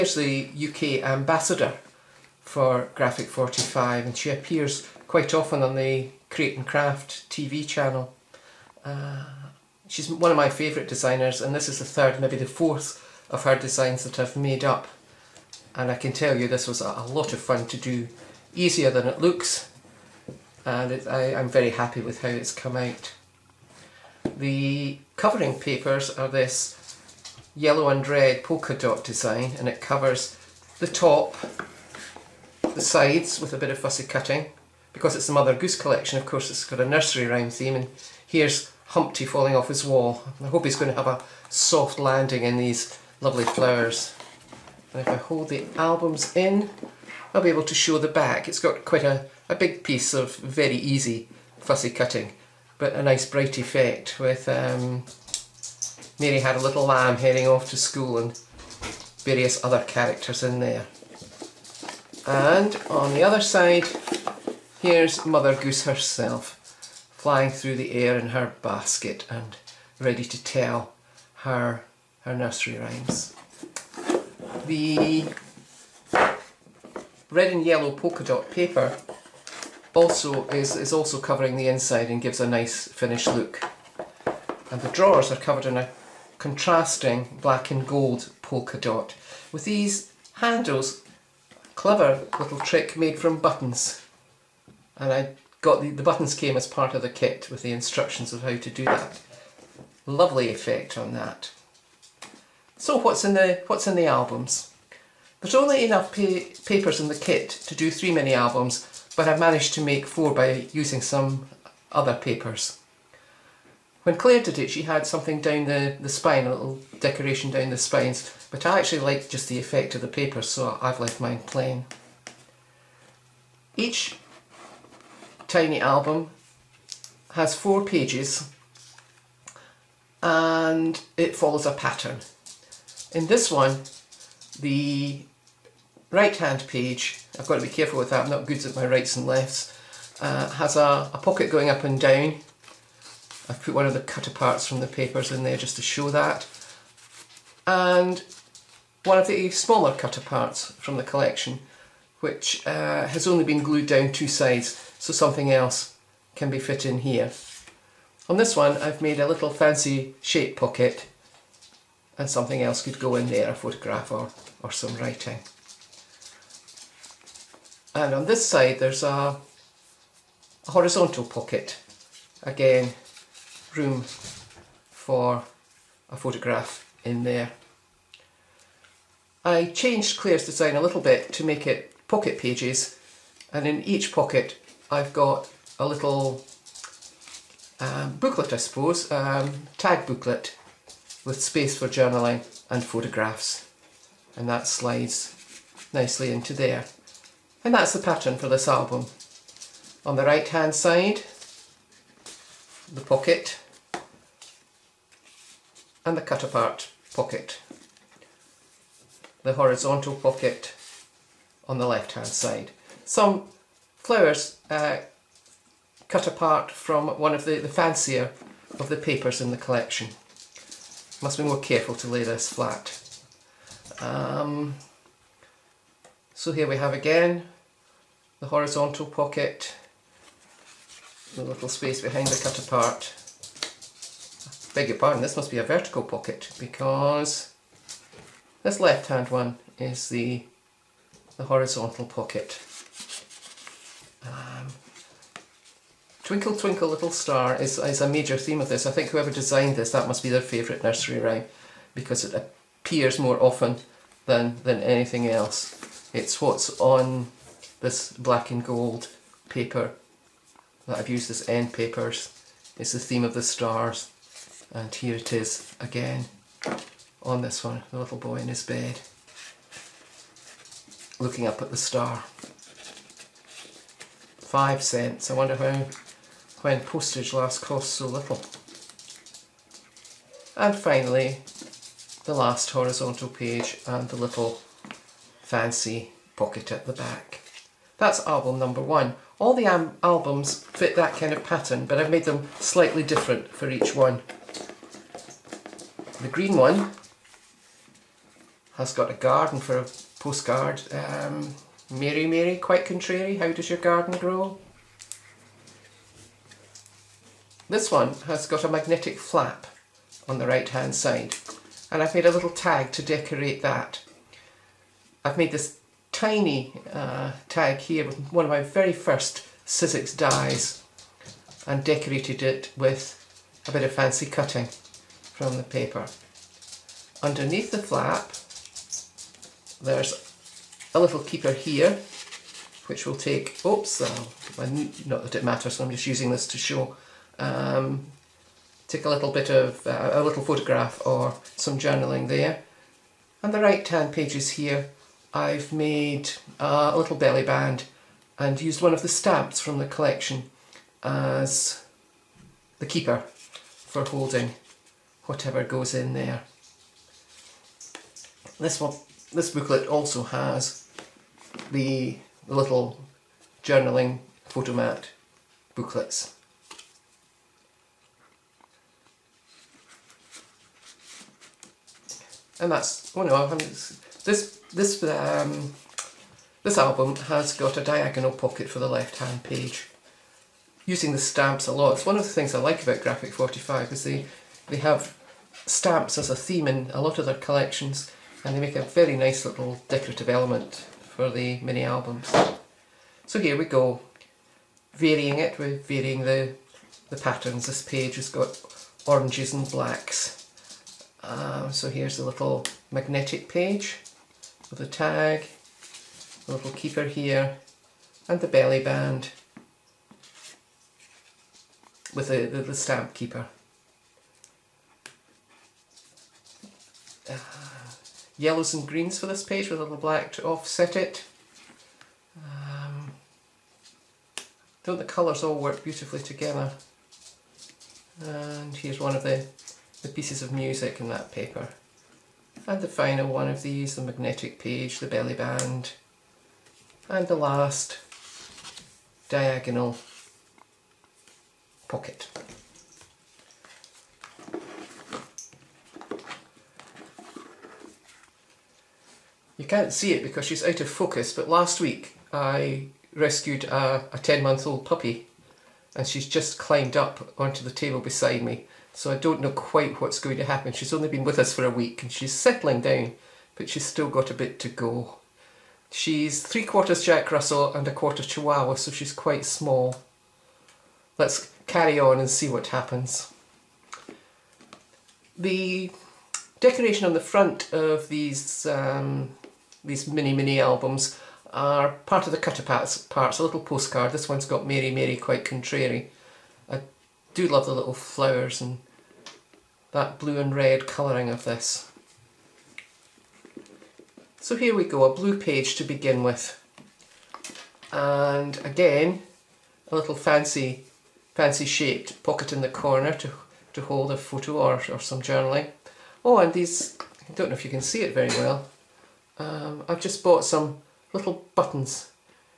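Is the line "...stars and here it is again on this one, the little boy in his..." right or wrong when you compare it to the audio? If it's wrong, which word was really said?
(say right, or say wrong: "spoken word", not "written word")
right.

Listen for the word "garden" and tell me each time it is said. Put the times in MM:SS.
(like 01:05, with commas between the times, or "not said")
04:59, 05:03.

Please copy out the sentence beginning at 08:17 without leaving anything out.
And again, a little fancy fancy shaped pocket in the corner to, to hold a photo or, or some journaling.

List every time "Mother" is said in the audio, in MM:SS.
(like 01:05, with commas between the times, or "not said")
00:35, 01:05.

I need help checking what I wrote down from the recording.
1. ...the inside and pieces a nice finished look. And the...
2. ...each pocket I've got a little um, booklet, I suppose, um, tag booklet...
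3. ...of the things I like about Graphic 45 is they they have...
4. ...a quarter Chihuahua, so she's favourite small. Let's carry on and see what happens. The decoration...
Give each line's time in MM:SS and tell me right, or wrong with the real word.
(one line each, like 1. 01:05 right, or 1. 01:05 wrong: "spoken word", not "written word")
1. 01:21 wrong: "gives", not "pieces"
2. 03:03 right
3. 06:22 right
4. 07:47 wrong: "quite", not "favourite".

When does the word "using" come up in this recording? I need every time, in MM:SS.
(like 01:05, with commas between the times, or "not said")
01:50, 05:36, 06:20.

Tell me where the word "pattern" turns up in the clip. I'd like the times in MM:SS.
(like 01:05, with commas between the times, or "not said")
02:11, 03:17, 04:51, 06:37.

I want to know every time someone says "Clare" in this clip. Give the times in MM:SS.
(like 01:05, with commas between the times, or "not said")
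01:54, 03:00.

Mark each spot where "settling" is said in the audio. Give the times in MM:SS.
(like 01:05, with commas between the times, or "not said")
07:42.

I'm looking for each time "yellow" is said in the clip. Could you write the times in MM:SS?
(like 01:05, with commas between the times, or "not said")
00:27, 01:17, 06:58.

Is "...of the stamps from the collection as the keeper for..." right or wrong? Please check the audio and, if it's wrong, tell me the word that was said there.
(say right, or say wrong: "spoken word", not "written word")
right.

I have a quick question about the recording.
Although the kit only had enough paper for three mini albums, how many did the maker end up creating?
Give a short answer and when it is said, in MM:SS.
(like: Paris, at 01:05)
4, at 01:49.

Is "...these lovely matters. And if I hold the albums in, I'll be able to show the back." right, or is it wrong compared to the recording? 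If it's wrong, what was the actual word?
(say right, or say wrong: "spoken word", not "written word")
wrong: "flowers", not "matters".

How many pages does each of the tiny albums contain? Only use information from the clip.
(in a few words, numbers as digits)
4.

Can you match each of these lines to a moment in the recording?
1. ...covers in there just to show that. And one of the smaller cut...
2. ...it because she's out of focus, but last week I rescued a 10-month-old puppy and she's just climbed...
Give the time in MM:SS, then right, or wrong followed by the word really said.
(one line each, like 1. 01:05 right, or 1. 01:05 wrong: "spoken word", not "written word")
1. 02:24 wrong: "papers", not "covers"
2. 07:30 right.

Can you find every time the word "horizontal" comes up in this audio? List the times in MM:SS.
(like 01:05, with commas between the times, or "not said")
02:50, 03:29, 03:48, 04:01, 04:42.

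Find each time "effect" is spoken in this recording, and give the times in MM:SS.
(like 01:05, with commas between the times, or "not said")
00:53, 01:40, 01:59.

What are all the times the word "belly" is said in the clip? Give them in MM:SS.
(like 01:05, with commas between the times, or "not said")
05:47, 06:48, 07:15.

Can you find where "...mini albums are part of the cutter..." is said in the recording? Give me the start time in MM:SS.
08:00.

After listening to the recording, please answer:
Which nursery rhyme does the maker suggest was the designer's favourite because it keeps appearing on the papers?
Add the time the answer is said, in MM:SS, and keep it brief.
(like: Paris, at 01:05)
Twinkle Twinkle Little Star, at 04:06.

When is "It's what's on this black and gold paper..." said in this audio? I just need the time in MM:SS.
04:16.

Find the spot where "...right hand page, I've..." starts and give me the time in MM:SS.
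02:16.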